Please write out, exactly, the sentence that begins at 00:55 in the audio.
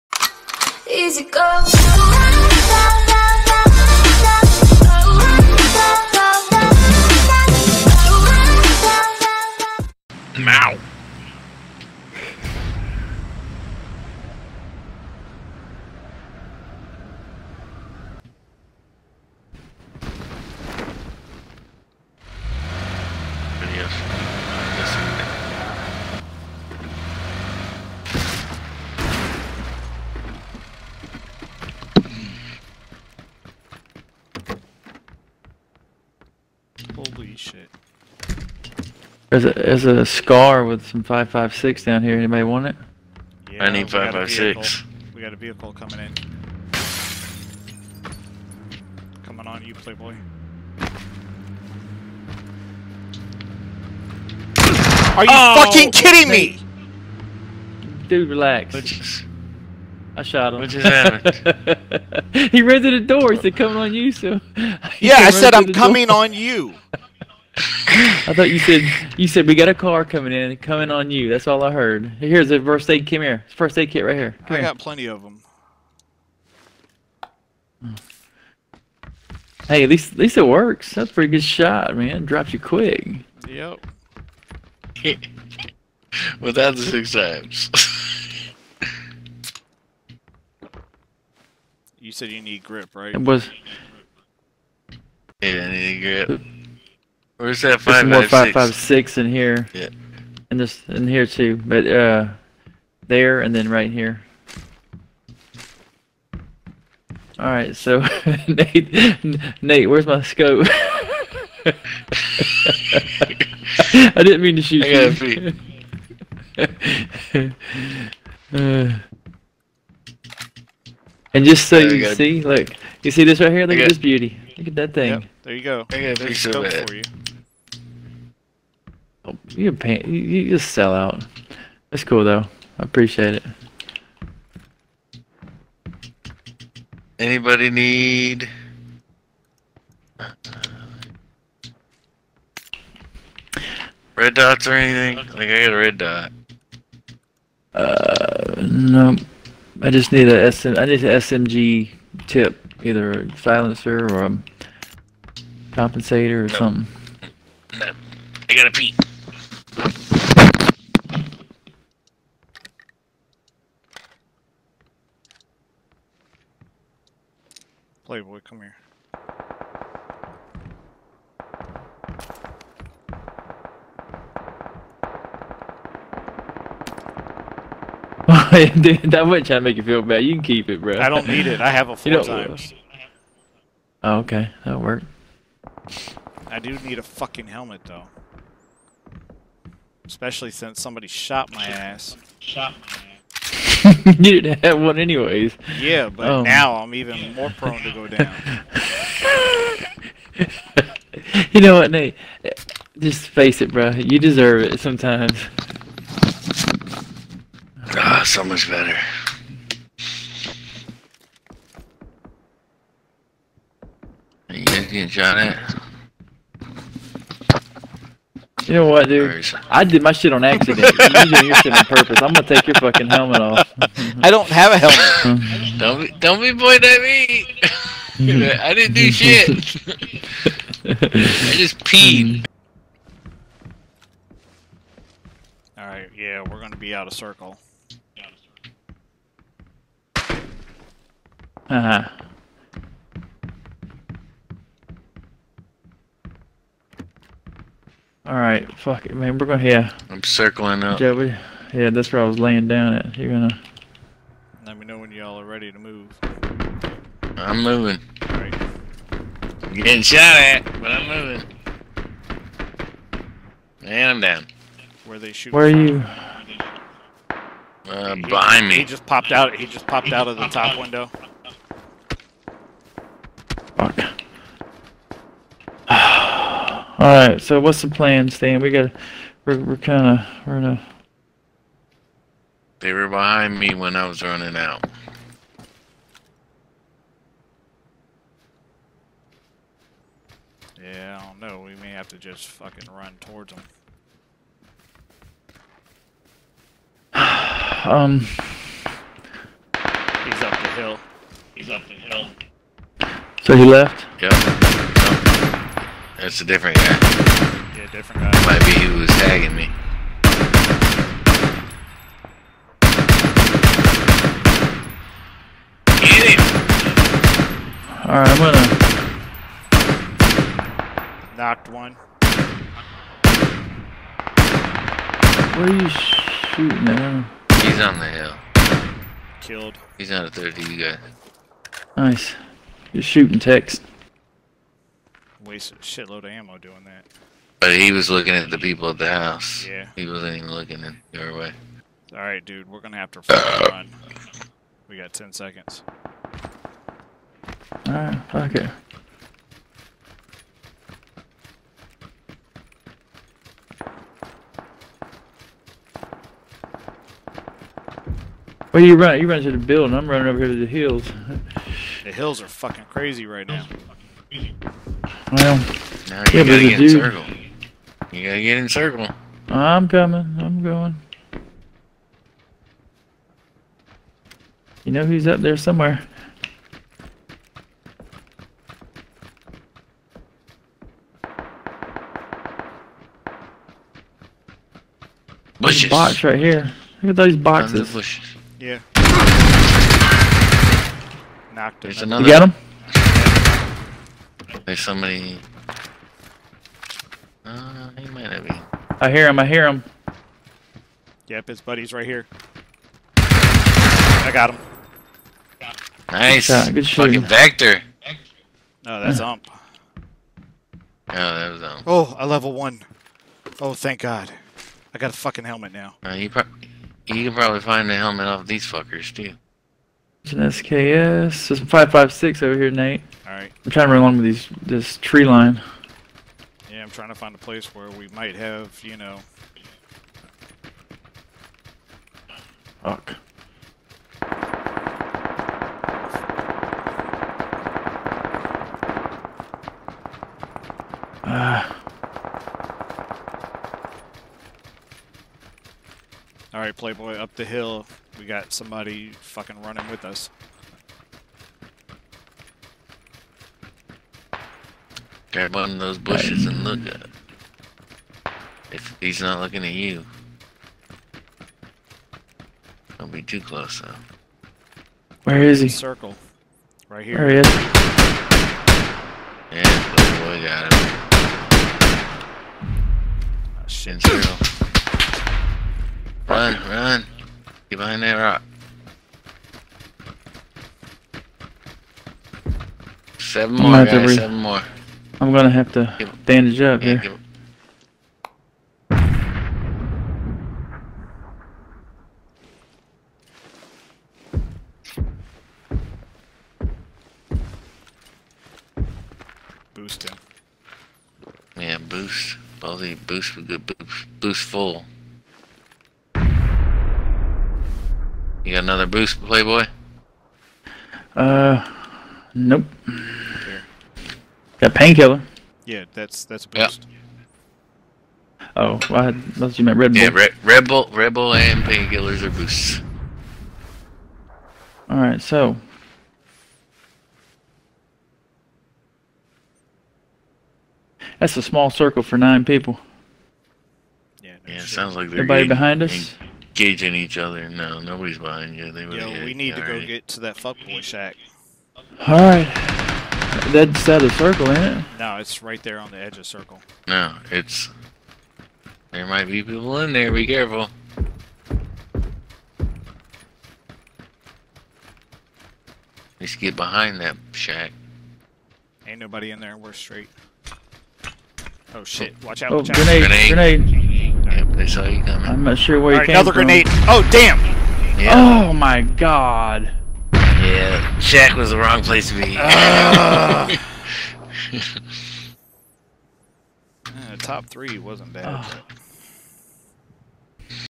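Are you oh, fucking kidding me?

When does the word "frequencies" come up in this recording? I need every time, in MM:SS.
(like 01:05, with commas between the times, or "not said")
not said.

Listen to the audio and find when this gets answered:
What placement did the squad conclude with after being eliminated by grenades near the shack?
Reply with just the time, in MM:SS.
09:37.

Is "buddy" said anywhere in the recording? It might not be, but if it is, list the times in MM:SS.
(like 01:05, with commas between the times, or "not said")
06:41.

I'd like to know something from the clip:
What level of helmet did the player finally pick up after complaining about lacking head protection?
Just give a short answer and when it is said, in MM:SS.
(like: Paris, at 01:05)
level 1, at 06:52.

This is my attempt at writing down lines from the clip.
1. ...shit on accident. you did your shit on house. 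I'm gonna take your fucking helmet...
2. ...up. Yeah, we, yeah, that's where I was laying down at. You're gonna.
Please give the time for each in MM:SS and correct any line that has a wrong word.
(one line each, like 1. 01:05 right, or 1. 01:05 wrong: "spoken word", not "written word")
1. 03:40 wrong: "purpose", not "house"
2. 04:10 right.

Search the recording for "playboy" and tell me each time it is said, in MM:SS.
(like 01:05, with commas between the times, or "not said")
00:49, 02:48, 07:26, 08:29.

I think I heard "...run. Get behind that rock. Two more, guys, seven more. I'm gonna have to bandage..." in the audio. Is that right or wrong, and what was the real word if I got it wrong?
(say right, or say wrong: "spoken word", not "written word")
wrong: "Seven", not "Two".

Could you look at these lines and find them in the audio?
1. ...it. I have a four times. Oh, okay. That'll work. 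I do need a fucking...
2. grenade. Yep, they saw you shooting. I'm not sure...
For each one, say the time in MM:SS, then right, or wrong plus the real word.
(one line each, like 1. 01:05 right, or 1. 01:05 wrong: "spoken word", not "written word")
1. 03:01 right
2. 09:23 wrong: "coming", not "shooting".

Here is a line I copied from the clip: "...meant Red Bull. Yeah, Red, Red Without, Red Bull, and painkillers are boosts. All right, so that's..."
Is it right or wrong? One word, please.
wrong.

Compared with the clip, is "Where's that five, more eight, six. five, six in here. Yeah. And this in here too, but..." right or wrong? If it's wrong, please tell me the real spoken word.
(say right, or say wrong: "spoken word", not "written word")
wrong: "five", not "eight".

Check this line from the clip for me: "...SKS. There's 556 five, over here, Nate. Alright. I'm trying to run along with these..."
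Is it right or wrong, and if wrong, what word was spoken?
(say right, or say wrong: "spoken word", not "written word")
right.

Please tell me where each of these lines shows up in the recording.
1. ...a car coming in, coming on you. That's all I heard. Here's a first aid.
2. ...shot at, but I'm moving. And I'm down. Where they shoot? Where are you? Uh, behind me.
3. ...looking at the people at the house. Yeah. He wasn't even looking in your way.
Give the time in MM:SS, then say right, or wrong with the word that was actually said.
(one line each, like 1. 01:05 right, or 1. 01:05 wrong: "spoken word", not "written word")
1. 01:09 right
2. 04:20 right
3. 05:38 right.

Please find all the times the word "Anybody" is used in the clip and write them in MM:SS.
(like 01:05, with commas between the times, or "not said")
00:42, 02:17.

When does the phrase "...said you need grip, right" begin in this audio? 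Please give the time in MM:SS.
01:32.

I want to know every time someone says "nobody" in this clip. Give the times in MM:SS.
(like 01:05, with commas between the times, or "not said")
08:57, 09:18.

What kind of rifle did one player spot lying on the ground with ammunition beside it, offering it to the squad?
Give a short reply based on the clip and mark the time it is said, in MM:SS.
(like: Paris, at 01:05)
SCAR, at 00:40.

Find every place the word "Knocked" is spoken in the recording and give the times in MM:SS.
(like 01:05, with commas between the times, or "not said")
05:21, 06:31.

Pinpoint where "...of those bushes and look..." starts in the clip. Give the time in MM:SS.
07:35.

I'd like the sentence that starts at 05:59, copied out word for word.
I'm running over here to the hills.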